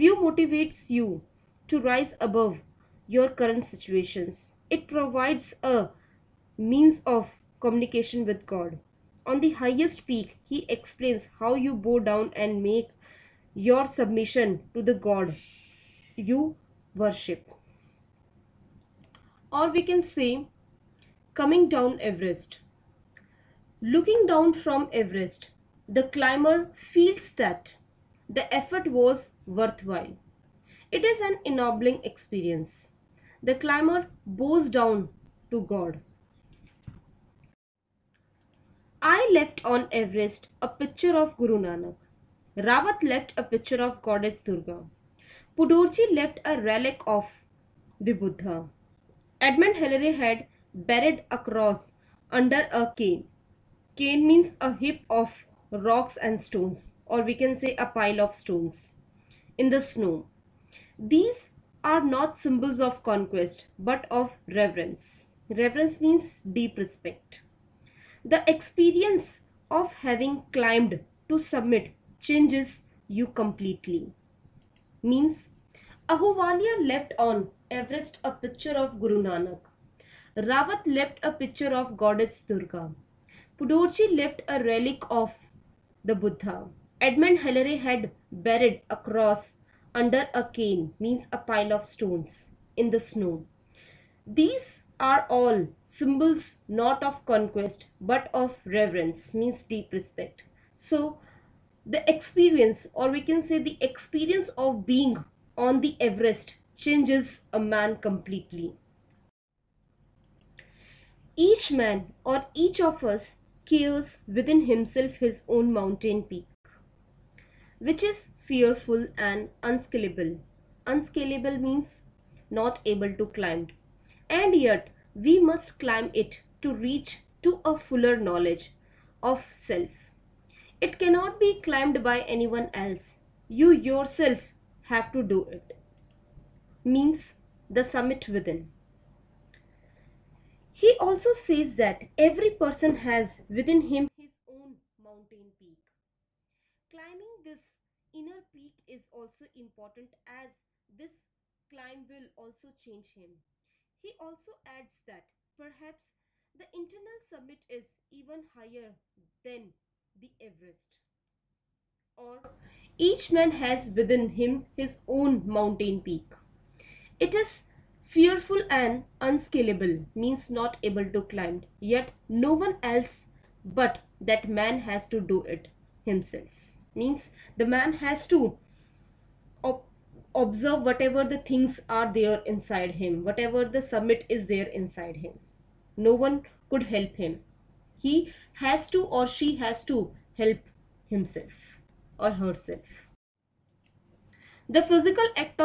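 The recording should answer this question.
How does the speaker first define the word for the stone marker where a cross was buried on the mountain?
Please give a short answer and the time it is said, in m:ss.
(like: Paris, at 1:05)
a heap of rocks and stones, at 0:54.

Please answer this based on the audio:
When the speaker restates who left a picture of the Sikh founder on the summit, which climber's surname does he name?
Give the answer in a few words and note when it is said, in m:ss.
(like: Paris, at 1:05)
Ahluwalia, at 1:16.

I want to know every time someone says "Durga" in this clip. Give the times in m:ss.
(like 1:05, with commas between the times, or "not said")
0:44, 1:22.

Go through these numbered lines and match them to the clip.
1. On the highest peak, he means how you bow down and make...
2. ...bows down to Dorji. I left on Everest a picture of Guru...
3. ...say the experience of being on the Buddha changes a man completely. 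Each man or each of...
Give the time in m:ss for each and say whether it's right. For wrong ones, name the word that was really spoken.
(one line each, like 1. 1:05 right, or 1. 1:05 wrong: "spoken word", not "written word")
1. 0:09 wrong: "explains", not "means"
2. 0:34 wrong: "God", not "Dorji"
3. 1:43 wrong: "Everest", not "Buddha".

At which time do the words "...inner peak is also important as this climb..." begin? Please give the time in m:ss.
2:28.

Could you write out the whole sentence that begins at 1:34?
These are all symbols not of conquest but of reverence, means deep respect.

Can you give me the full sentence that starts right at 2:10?
It cannot be climbed by anyone else.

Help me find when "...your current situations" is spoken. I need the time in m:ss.
0:03.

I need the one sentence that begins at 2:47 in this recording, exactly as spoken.
It is fearful and unscalable, means not able to climb, yet no one else but that man has to do it himself.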